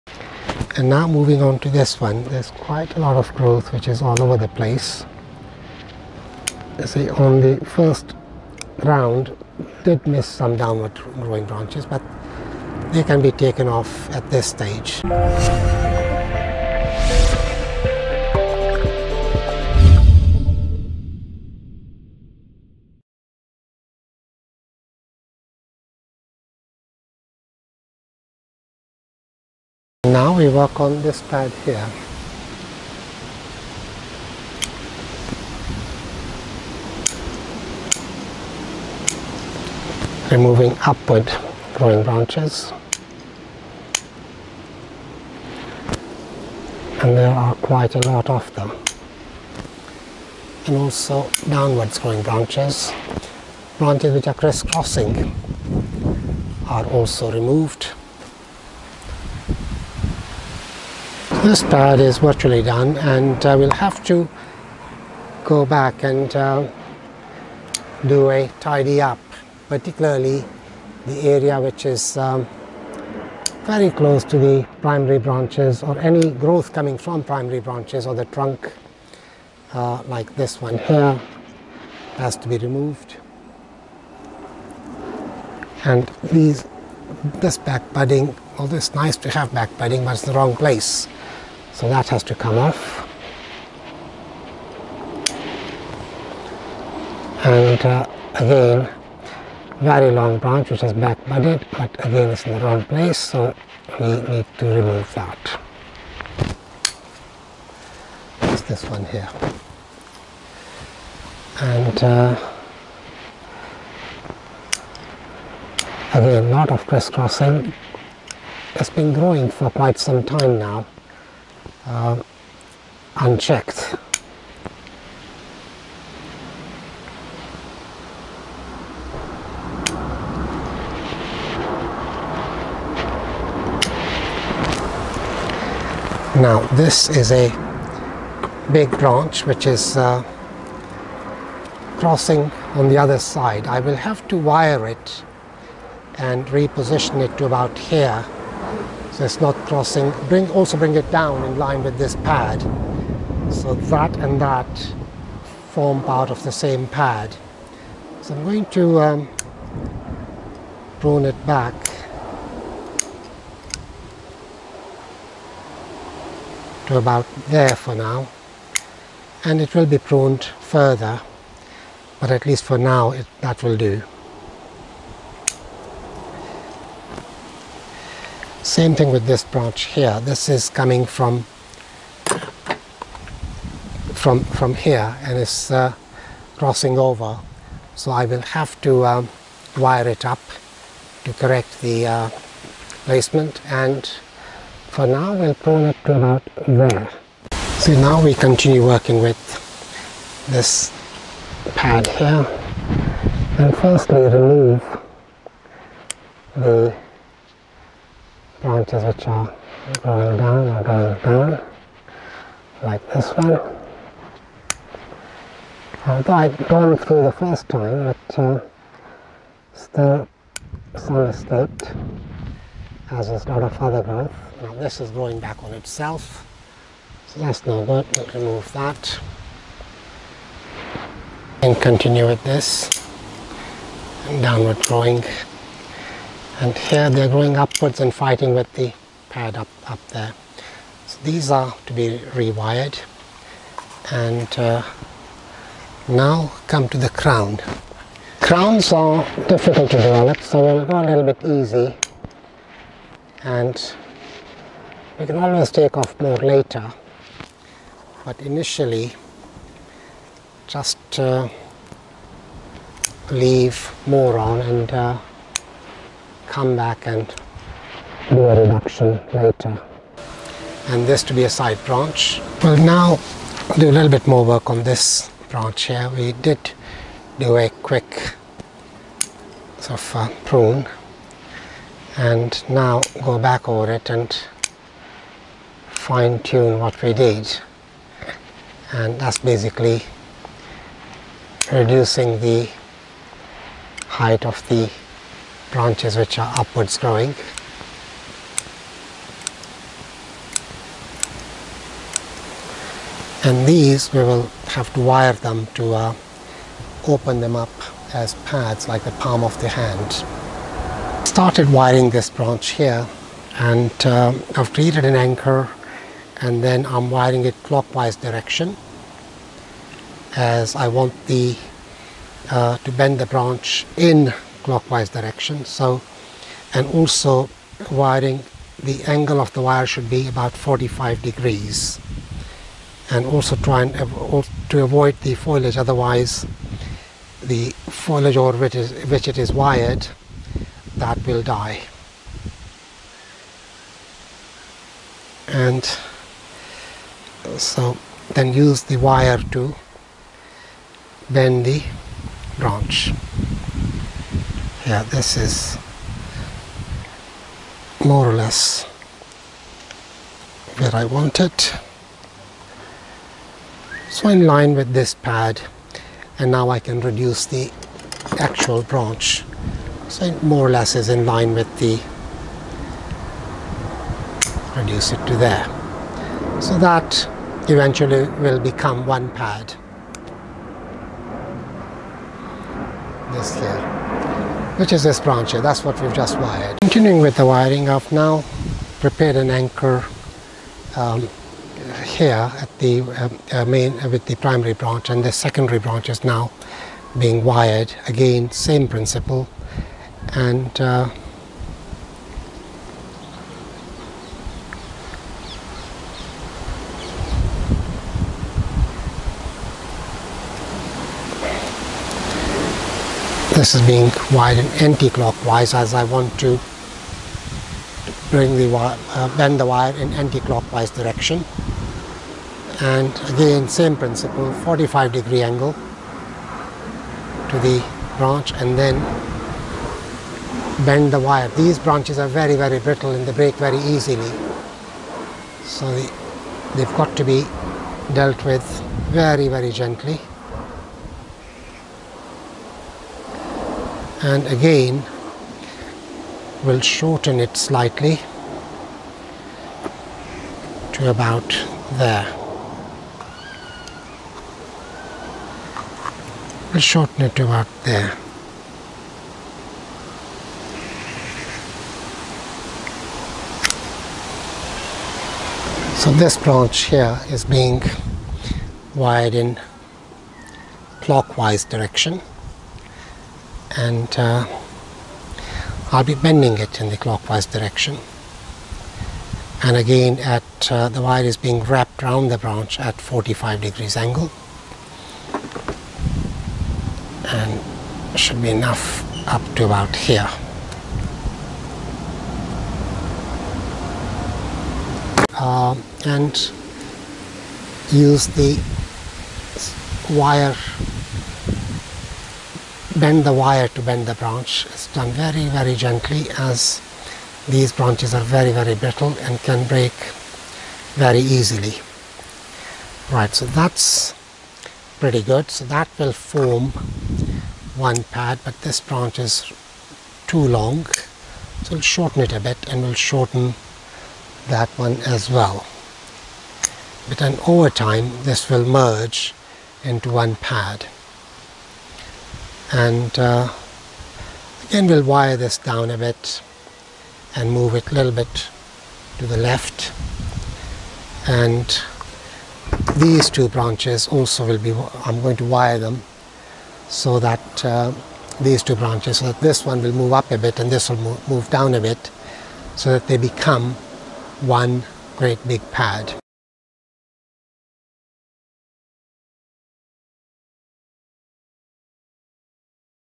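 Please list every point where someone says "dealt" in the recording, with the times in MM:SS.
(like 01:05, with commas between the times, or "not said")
07:18.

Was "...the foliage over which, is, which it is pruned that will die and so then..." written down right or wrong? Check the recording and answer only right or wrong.
wrong.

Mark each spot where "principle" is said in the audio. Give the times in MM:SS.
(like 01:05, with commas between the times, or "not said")
06:38, 07:03.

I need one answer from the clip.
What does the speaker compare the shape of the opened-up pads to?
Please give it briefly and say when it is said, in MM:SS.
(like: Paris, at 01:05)
palm of the hand, at 05:09.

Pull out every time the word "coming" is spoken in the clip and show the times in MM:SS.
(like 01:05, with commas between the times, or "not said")
01:16, 03:00.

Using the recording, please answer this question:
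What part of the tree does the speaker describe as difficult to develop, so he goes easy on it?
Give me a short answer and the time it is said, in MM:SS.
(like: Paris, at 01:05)
crown, at 04:08.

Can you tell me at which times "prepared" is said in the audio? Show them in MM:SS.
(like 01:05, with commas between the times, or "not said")
06:28.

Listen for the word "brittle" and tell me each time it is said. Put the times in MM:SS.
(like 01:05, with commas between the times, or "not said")
07:12, 08:28.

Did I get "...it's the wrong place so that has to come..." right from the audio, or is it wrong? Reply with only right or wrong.
right.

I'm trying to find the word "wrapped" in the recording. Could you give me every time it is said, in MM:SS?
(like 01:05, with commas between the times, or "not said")
08:01.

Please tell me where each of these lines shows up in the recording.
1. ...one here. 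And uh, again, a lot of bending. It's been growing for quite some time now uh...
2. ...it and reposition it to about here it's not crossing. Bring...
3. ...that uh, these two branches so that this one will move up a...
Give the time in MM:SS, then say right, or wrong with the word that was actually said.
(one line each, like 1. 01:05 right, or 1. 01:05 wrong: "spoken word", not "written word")
1. 01:48 wrong: "crisscrossing", not "bending"
2. 02:24 right
3. 09:07 right.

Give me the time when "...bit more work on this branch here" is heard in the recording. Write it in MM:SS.
04:34.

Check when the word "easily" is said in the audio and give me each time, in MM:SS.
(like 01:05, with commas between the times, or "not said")
07:13, 08:31.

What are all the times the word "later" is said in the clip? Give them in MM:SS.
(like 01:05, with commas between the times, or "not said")
04:16, 04:29.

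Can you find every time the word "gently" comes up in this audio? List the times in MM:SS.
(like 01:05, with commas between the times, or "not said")
07:19, 08:25.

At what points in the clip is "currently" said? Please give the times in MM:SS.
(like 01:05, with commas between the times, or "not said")
not said.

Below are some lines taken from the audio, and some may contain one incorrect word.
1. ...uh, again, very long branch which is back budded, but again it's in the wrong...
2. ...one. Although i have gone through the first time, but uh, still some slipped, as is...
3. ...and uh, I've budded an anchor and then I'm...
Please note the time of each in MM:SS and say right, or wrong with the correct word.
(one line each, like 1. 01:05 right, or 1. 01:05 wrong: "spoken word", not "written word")
1. 01:37 right
2. 03:33 right
3. 05:13 wrong: "created", not "budded".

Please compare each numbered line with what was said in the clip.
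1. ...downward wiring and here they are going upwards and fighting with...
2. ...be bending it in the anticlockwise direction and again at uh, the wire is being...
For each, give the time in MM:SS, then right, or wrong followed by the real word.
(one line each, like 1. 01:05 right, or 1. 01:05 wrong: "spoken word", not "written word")
1. 03:54 wrong: "growing", not "wiring"
2. 07:56 wrong: "clockwise", not "anticlockwise".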